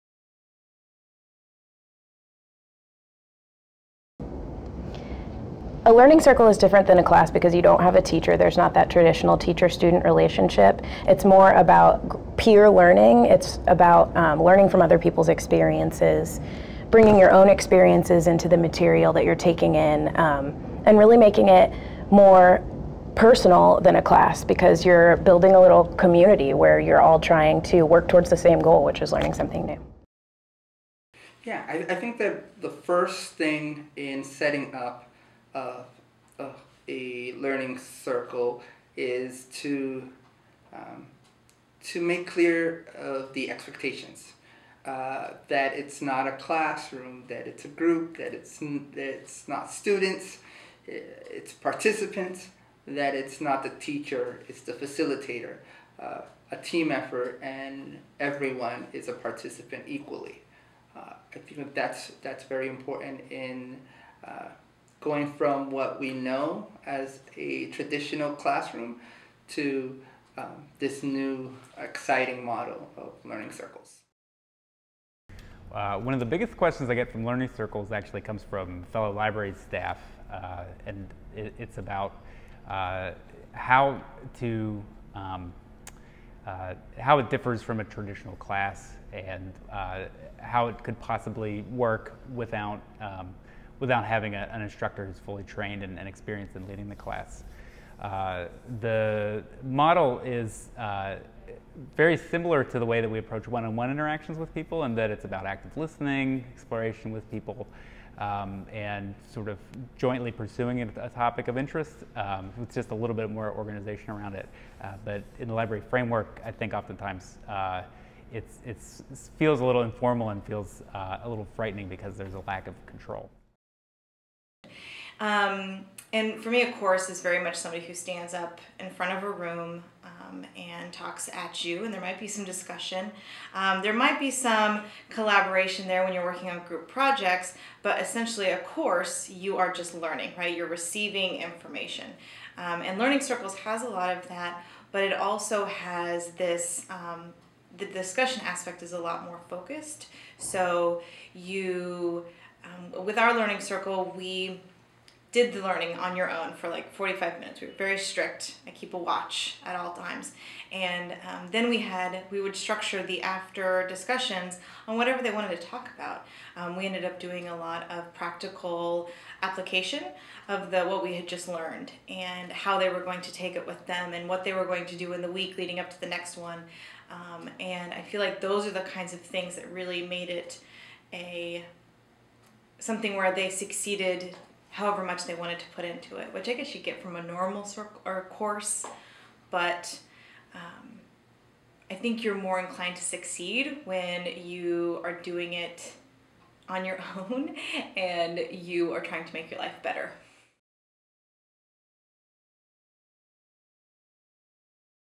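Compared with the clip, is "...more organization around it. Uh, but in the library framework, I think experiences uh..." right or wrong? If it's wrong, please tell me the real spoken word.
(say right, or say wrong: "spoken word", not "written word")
wrong: "oftentimes", not "experiences".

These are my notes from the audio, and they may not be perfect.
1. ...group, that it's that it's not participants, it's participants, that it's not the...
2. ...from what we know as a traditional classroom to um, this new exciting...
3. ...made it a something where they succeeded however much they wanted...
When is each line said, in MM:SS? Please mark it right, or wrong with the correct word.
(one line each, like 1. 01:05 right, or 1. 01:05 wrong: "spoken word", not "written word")
1. 00:47 wrong: "students", not "participants"
2. 01:05 right
3. 03:00 right.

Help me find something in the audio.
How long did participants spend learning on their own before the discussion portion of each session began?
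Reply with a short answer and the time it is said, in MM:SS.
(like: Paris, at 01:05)
45 minutes, at 02:36.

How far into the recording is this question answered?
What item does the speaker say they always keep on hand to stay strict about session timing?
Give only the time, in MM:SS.
02:38.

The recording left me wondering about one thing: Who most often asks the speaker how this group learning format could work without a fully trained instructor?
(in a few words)
fellow library staff.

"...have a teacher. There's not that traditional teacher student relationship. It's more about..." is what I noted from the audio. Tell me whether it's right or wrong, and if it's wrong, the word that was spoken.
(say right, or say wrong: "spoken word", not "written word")
right.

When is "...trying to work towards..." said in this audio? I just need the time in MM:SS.
00:27.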